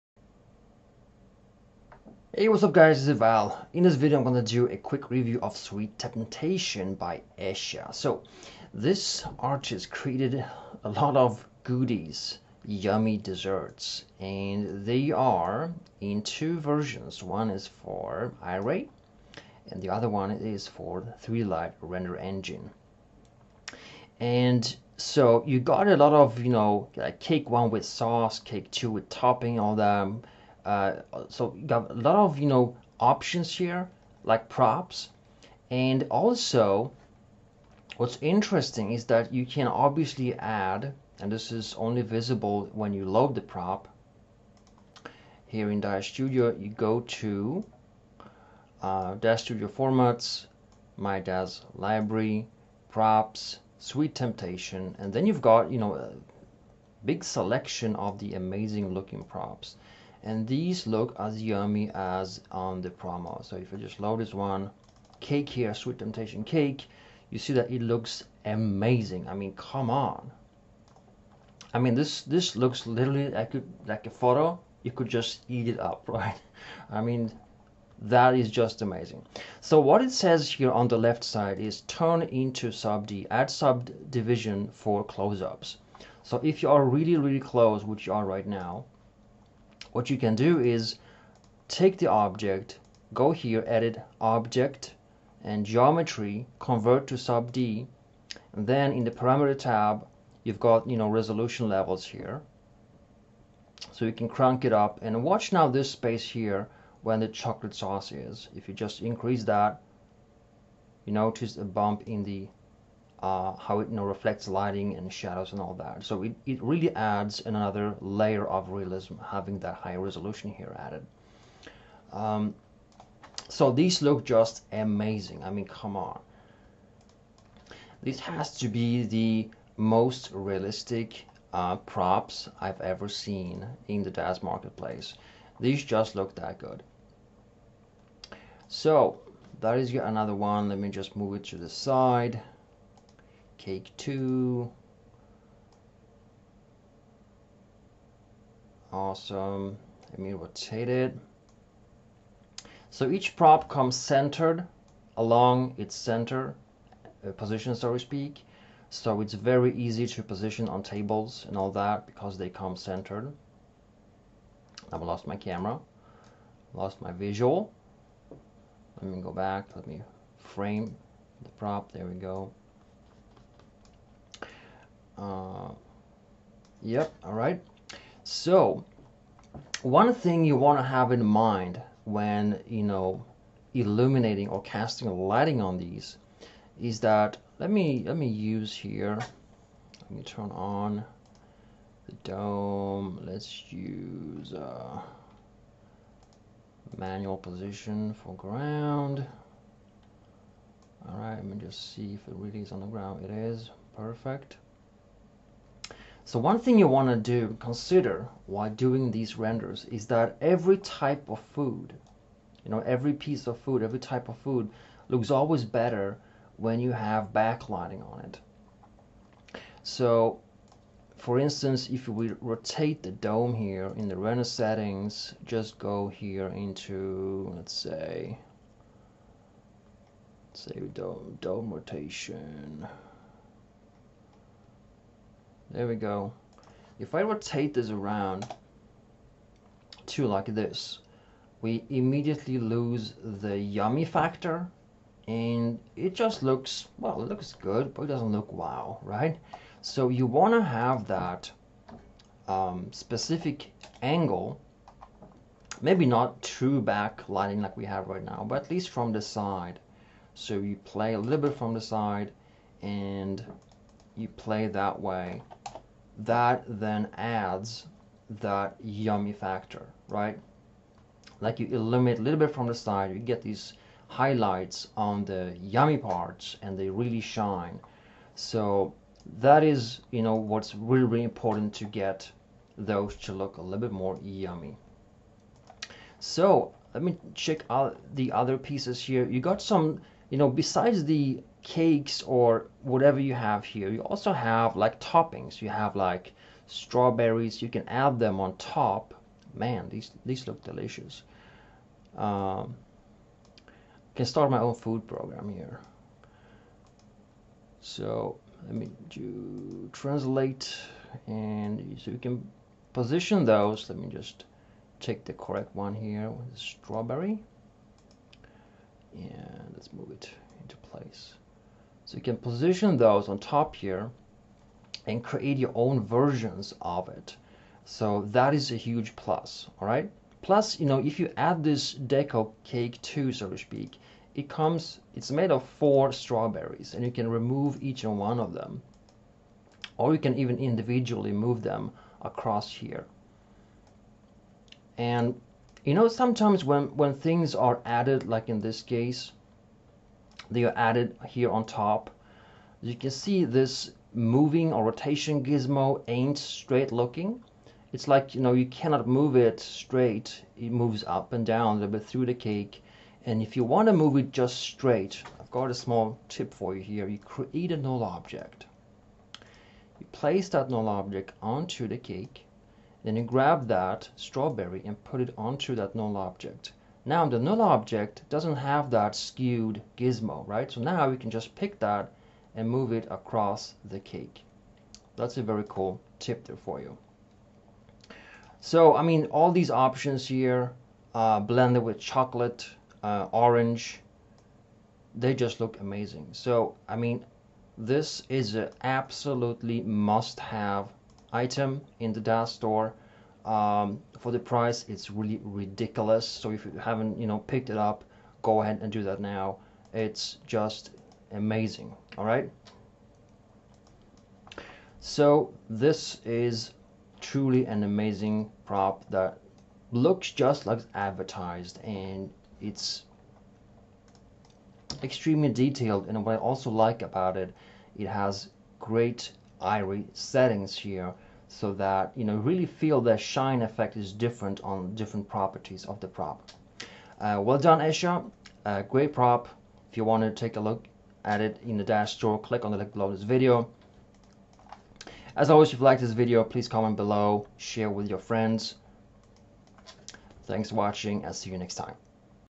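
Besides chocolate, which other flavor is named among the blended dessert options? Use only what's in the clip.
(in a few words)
Orange.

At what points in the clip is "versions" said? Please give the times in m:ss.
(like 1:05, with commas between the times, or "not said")
0:16, 5:26.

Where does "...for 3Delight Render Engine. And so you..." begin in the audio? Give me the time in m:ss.
0:20.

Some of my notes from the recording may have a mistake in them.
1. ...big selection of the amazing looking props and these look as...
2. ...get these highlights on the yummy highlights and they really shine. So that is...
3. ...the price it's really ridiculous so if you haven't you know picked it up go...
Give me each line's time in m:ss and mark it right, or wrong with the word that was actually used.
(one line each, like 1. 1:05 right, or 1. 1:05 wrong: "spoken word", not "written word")
1. 0:57 right
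2. 4:33 wrong: "parts", not "highlights"
3. 6:44 right.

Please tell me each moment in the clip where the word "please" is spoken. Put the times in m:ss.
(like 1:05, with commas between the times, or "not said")
7:26.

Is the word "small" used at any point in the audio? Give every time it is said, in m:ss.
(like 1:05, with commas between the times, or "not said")
6:05.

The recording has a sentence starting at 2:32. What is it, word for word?
So each prop comes centered along its center uh, position, so to speak.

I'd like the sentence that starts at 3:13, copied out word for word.
Let's use uh, manual position for ground.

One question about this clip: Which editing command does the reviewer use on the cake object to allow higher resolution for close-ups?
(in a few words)
Convert to Sub D.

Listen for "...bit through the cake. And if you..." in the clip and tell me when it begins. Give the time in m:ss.
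6:01.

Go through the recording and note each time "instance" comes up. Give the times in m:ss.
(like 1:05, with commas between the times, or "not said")
3:41.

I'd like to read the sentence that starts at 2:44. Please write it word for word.
I've lost my camera, lost my visual.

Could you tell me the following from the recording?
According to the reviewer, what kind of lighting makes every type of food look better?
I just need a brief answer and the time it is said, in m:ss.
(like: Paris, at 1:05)
Backlighting, at 3:37.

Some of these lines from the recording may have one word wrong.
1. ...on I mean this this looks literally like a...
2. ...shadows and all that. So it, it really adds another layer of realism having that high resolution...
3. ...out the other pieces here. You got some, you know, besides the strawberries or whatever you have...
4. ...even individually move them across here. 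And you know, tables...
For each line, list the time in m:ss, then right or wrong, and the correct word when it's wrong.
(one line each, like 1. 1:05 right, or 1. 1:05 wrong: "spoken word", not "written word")
1. 1:09 right
2. 1:55 right
3. 4:47 wrong: "cakes", not "strawberries"
4. 5:40 wrong: "sometimes", not "tables".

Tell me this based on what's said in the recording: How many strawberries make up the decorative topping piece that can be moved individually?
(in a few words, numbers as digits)
4.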